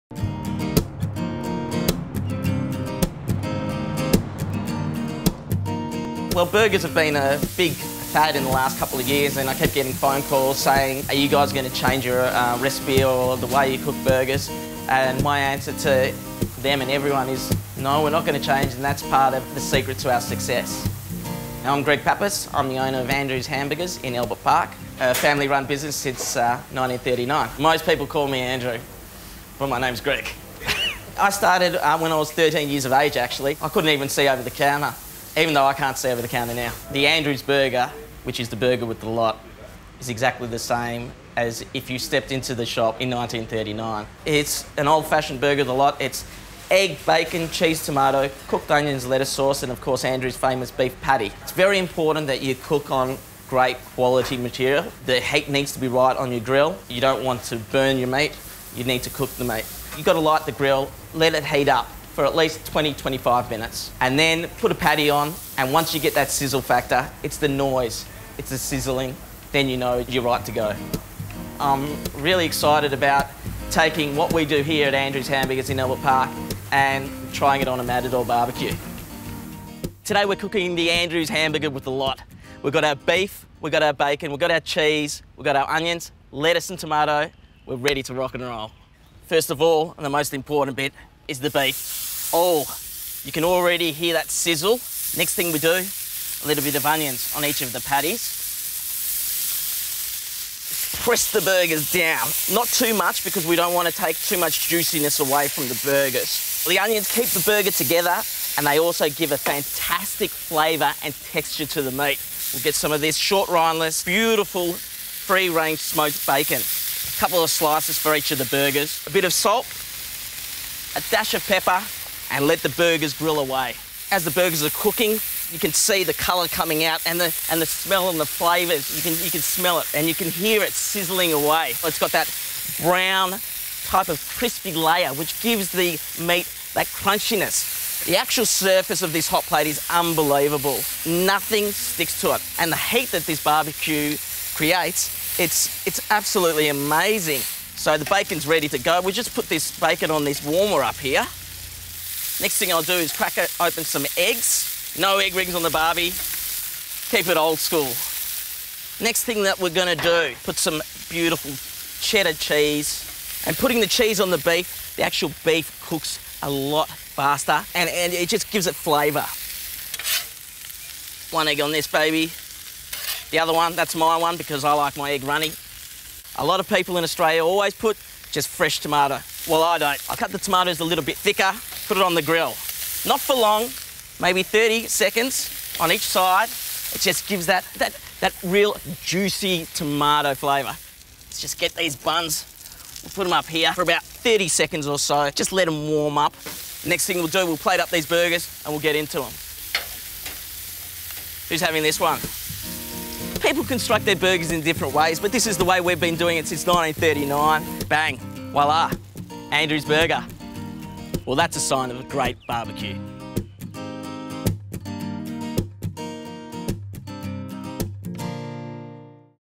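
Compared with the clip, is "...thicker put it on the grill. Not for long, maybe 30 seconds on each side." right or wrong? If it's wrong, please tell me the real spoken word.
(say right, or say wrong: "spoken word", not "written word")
right.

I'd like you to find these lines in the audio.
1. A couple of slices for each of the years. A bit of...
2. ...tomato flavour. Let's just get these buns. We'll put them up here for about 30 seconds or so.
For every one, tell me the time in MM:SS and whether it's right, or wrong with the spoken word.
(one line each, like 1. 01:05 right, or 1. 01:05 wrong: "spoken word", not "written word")
1. 01:56 wrong: "burgers", not "years"
2. 03:09 right.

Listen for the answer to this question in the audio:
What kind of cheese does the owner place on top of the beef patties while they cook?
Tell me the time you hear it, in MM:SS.
02:42.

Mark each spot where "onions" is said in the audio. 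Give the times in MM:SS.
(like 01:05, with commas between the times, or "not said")
00:48, 01:25, 01:36, 01:46.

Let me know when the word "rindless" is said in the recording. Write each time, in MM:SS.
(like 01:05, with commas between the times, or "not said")
01:53.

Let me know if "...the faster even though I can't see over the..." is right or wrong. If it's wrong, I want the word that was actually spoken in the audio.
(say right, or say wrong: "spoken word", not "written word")
wrong: "counter", not "faster".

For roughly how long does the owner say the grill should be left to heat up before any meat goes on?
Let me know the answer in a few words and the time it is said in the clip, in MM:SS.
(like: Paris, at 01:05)
20 to 25 minutes, at 01:02.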